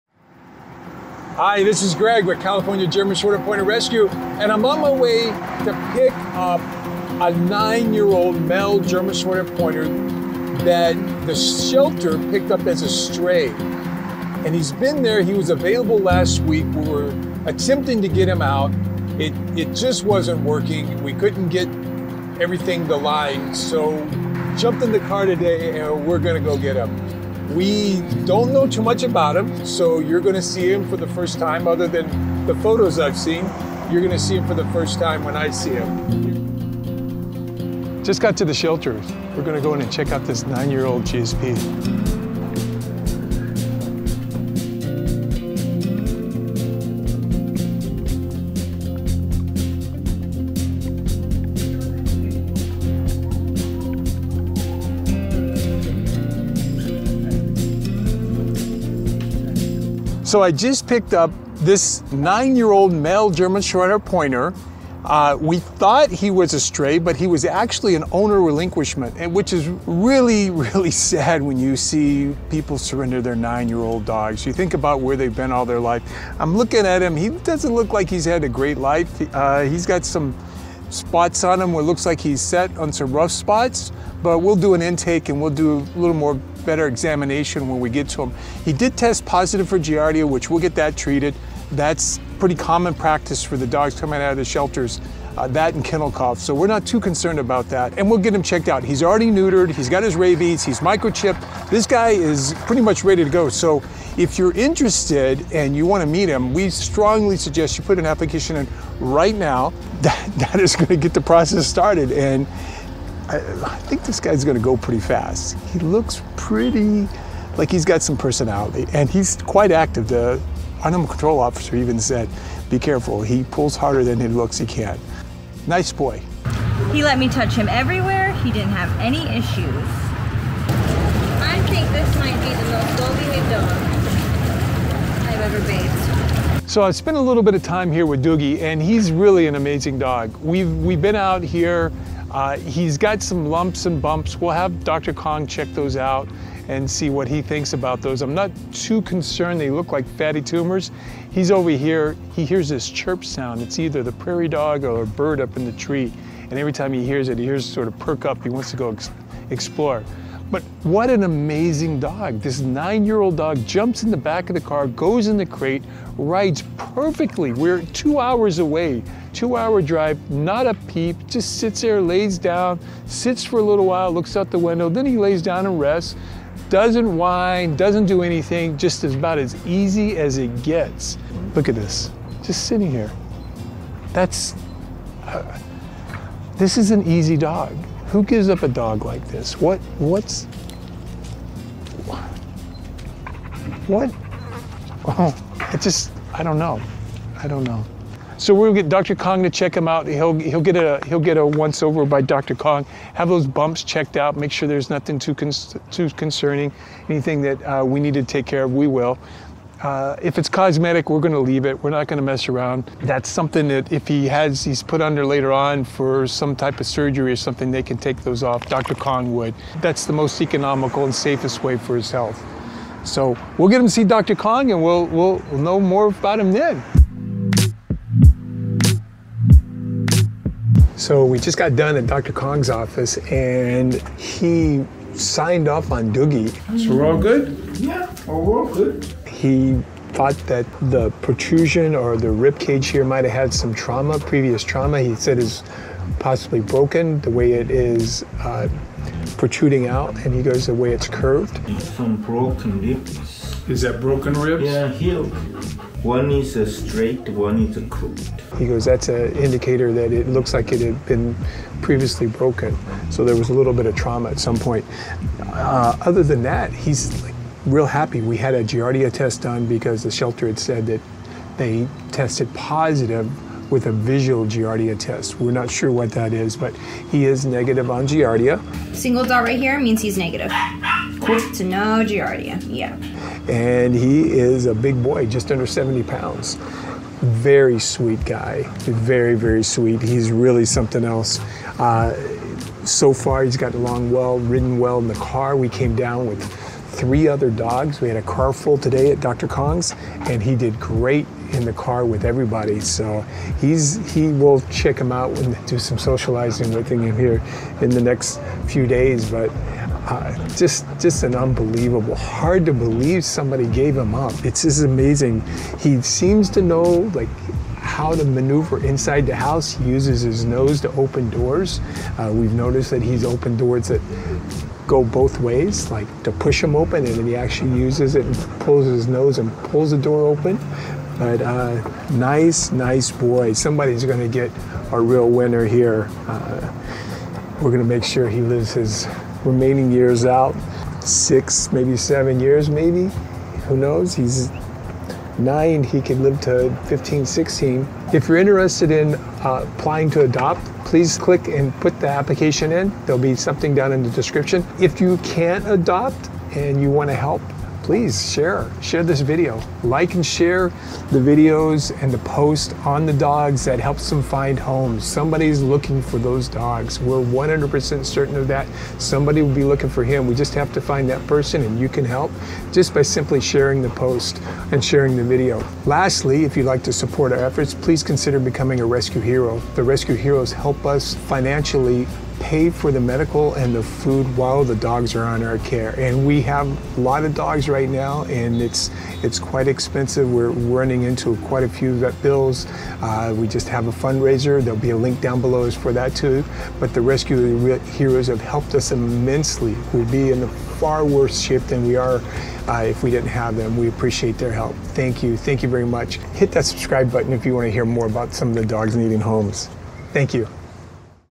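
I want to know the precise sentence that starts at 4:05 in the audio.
He said is possibly broken the way it is uh, protruding out, and he goes the way it's curved.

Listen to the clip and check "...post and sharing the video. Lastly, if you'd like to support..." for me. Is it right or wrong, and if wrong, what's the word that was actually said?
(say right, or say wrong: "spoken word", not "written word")
right.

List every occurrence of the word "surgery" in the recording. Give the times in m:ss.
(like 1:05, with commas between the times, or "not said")
3:36.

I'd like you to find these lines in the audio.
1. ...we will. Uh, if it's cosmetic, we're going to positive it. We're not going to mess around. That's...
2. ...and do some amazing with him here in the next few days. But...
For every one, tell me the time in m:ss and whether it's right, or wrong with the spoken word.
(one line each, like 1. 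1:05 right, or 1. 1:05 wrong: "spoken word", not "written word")
1. 3:28 wrong: "leave", not "positive"
2. 5:05 wrong: "socializing", not "amazing".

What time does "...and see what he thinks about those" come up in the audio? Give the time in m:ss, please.
2:26.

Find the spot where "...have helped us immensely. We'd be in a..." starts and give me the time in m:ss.
6:38.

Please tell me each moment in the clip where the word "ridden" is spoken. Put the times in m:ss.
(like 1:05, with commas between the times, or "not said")
4:54.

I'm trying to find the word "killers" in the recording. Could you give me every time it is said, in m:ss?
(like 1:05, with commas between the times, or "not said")
not said.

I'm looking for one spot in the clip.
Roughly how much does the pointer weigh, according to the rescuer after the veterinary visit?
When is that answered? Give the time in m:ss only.
4:45.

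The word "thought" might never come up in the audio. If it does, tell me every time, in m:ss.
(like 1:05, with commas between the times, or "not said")
1:05, 4:00.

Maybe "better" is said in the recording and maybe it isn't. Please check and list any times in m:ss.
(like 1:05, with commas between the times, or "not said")
1:26.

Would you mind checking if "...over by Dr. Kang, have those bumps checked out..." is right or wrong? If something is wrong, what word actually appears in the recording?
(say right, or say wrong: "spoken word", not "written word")
right.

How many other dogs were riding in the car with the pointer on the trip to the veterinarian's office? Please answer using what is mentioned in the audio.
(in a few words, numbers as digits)
3.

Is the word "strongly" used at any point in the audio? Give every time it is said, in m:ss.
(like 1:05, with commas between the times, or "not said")
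1:46.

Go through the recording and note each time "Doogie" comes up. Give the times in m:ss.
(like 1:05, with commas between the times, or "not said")
2:18, 3:56.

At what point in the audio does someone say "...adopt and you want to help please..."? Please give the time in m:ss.
5:55.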